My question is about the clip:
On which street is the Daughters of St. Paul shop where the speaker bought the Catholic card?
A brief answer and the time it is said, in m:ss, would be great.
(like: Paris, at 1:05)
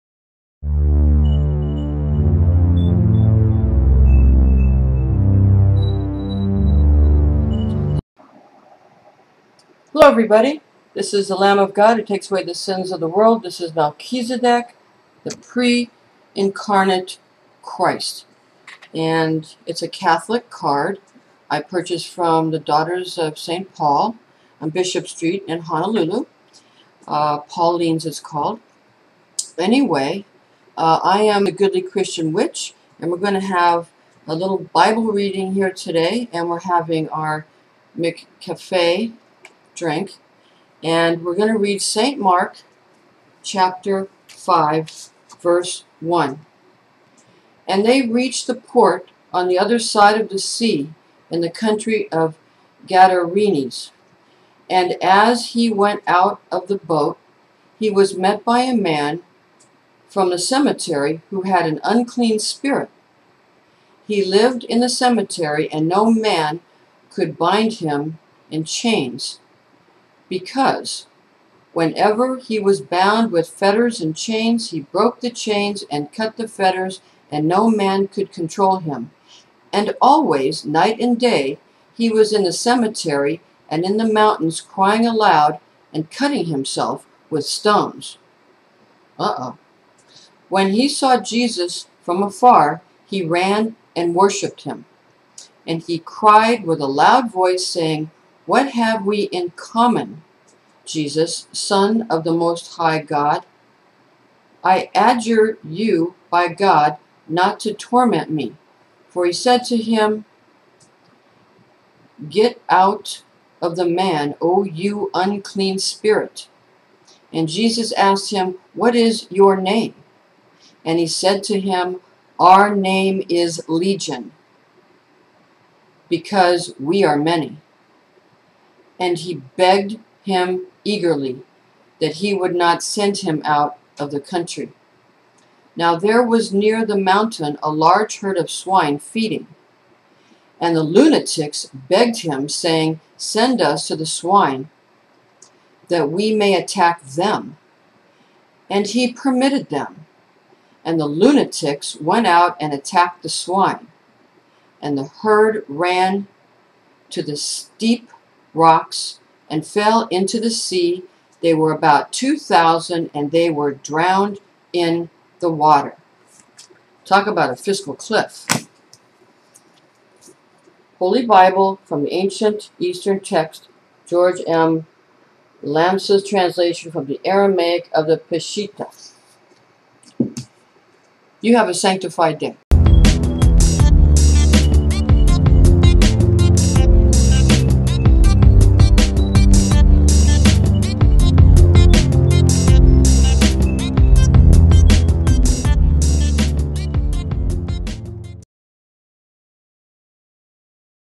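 Bishop Street, at 0:24.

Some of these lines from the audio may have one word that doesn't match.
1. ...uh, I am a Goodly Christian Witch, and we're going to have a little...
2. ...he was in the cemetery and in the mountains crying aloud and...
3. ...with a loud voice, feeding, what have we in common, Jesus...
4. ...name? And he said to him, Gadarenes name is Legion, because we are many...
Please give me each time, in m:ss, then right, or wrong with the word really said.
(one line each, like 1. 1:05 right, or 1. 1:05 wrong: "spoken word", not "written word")
1. 0:30 right
2. 1:21 right
3. 1:36 wrong: "saying", not "feeding"
4. 1:59 wrong: "Our", not "Gadarenes".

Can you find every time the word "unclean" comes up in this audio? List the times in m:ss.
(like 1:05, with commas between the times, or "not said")
1:01, 1:55.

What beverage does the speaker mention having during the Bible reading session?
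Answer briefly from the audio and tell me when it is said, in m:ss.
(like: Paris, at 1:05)
McCafe drink, at 0:37.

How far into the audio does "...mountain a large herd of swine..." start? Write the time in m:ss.
2:16.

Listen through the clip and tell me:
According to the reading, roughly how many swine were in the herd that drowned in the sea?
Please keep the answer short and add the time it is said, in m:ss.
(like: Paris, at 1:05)
2,000, at 2:42.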